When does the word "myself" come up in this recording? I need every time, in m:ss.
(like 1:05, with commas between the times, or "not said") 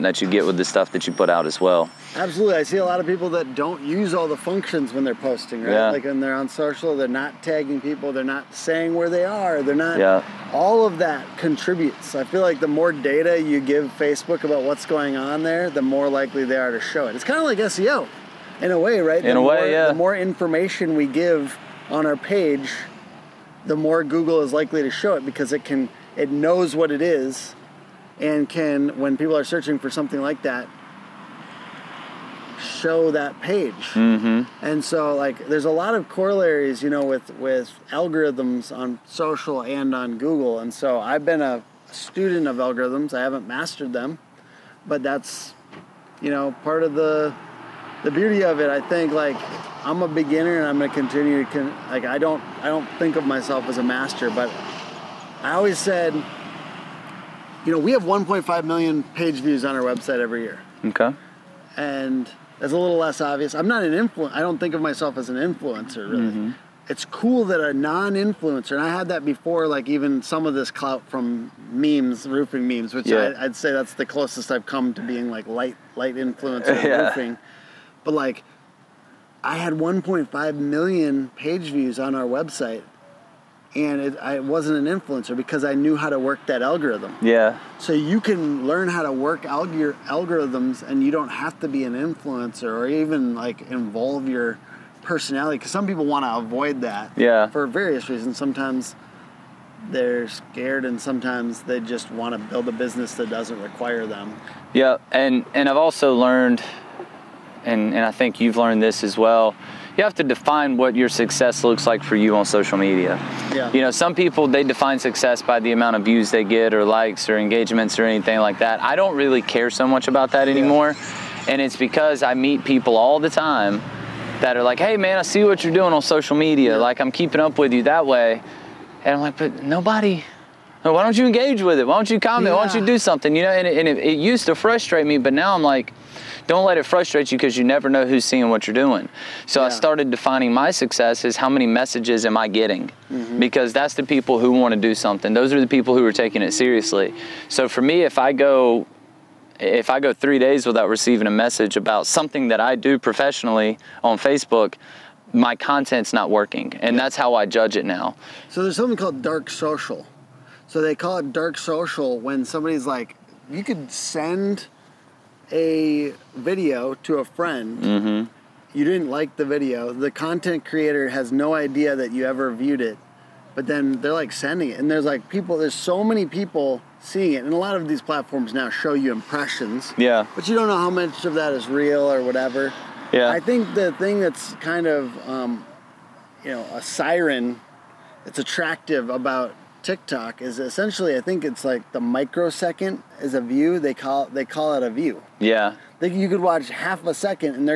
0:53, 1:04.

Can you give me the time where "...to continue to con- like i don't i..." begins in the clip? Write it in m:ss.
0:50.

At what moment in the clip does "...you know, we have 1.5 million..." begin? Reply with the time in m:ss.
0:57.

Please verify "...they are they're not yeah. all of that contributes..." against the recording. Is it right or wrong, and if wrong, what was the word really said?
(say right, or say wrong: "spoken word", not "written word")
right.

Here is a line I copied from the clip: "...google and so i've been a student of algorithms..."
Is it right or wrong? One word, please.
right.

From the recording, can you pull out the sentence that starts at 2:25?
Those are the people who are taking it seriously.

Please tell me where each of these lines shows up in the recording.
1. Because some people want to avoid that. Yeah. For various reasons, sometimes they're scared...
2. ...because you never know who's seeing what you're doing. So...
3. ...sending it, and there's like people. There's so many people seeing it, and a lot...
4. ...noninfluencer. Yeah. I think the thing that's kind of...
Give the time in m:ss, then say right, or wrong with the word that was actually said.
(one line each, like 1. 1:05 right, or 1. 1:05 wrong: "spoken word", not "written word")
1. 1:35 right
2. 2:17 right
3. 2:54 right
4. 3:02 wrong: "whatever", not "noninfluencer".